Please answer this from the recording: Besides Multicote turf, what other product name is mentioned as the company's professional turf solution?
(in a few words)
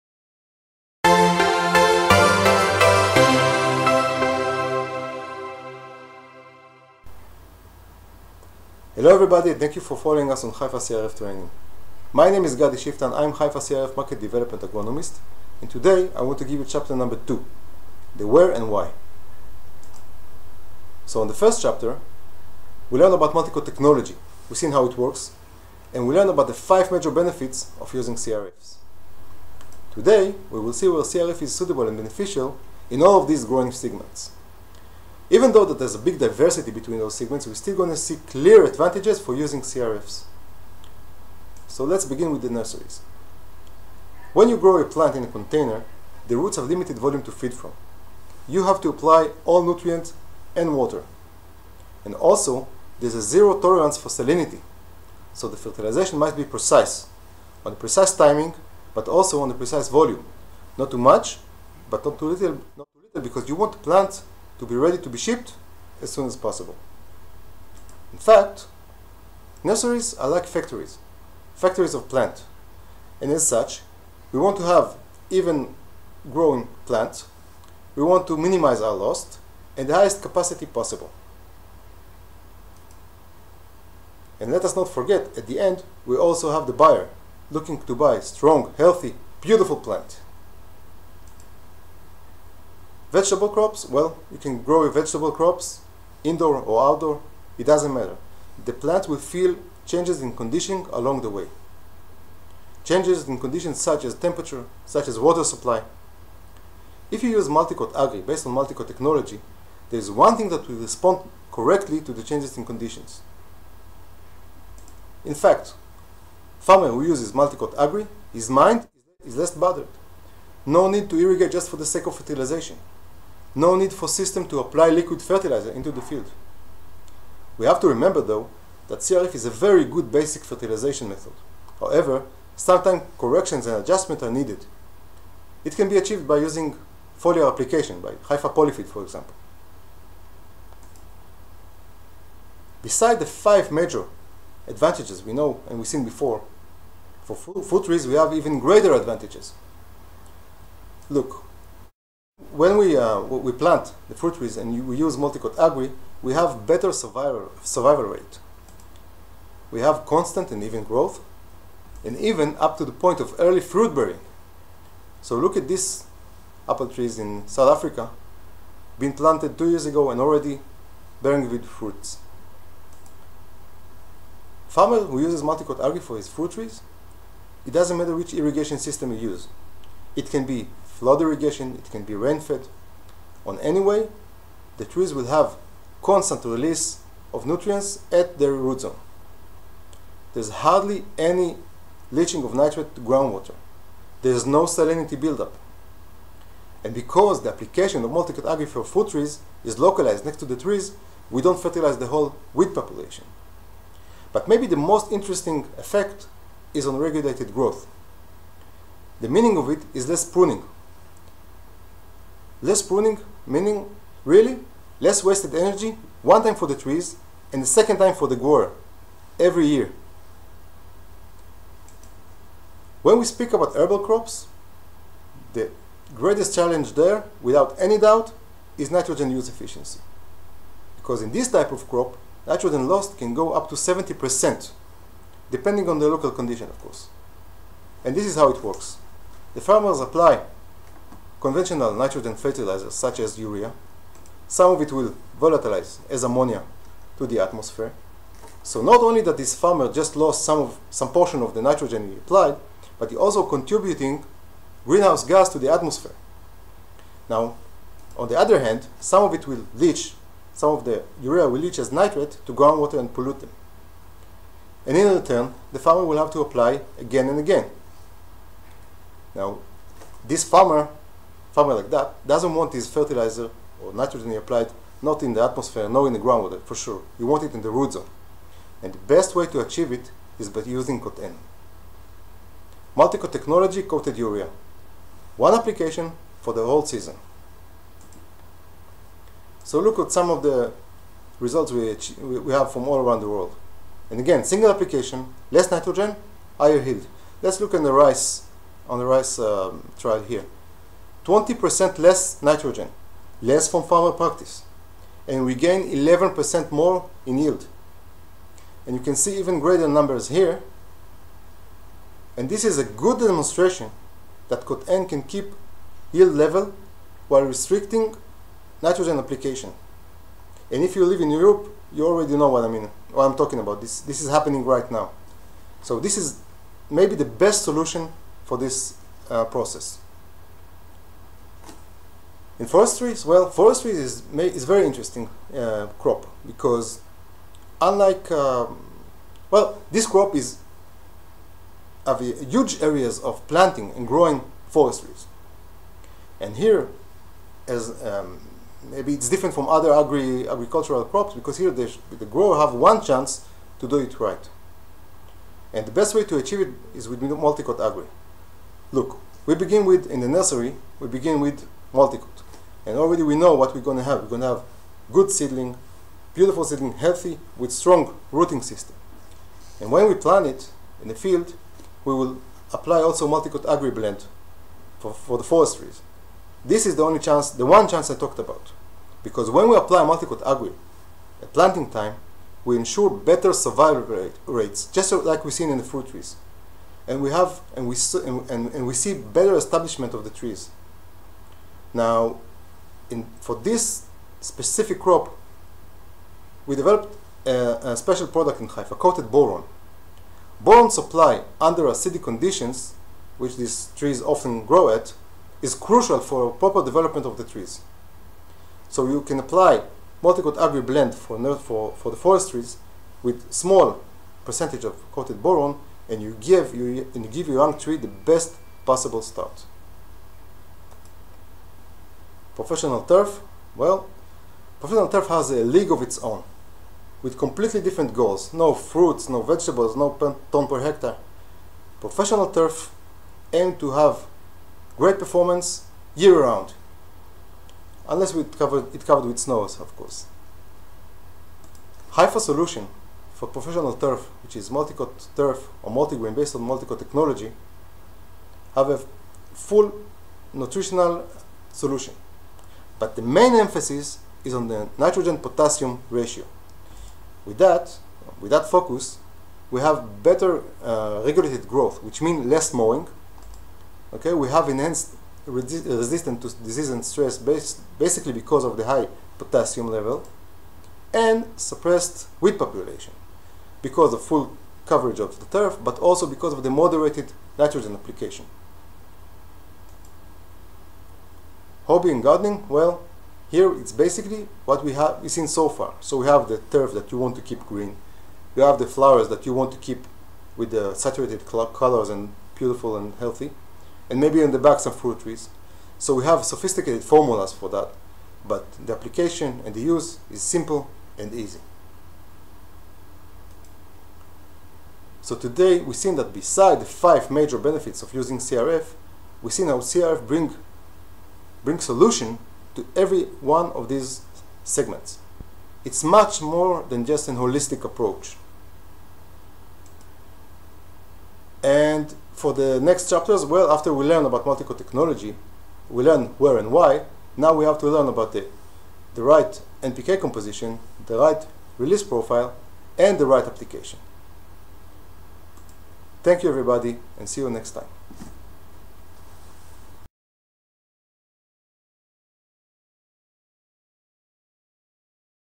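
Multigrain.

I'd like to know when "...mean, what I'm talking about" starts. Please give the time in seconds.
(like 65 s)
322 s.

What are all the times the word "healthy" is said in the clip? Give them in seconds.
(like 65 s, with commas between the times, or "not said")
88 s, 366 s, 493 s.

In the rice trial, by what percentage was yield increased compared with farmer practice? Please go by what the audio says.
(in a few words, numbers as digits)
11%.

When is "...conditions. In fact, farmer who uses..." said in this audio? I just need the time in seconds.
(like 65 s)
112 s.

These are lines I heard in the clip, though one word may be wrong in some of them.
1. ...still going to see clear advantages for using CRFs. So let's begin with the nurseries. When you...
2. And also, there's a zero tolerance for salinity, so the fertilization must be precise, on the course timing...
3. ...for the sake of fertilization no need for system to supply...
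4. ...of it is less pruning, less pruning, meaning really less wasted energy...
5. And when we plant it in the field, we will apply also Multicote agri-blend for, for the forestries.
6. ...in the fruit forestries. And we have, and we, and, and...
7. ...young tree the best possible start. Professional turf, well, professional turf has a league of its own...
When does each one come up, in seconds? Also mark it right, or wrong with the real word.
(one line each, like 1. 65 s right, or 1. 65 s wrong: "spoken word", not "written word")
1. 37 s right
2. 52 s wrong: "precise", not "course"
3. 121 s wrong: "apply", not "supply"
4. 209 s right
5. 369 s right
6. 385 s wrong: "trees", not "forestries"
7. 417 s right.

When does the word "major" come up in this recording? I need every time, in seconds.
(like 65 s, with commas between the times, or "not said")
26 s, 143 s, 507 s.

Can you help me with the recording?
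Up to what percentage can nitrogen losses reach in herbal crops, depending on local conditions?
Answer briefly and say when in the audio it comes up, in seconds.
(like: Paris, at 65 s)
70%, at 233 s.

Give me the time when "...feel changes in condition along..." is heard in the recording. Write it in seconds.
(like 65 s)
99 s.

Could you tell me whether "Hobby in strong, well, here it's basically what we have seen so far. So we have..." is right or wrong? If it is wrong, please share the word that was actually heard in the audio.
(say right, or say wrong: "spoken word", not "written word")
wrong: "gardening", not "strong".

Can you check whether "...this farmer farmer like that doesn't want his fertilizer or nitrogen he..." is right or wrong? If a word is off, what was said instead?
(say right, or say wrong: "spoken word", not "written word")
right.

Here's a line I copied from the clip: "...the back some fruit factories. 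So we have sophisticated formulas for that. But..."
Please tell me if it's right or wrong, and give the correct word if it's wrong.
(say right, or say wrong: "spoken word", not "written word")
wrong: "trees", not "factories".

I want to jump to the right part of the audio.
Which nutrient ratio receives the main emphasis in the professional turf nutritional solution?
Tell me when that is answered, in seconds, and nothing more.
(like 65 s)
454 s.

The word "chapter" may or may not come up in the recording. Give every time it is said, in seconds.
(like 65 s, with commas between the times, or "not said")
16 s, 21 s, 523 s.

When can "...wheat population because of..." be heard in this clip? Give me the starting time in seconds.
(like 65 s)
472 s.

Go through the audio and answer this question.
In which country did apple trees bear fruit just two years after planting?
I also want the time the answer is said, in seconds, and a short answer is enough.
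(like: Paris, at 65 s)
South Africa, at 167 s.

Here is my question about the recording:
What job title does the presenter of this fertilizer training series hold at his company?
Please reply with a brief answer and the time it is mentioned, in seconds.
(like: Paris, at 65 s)
Market Development Agronomist, at 13 s.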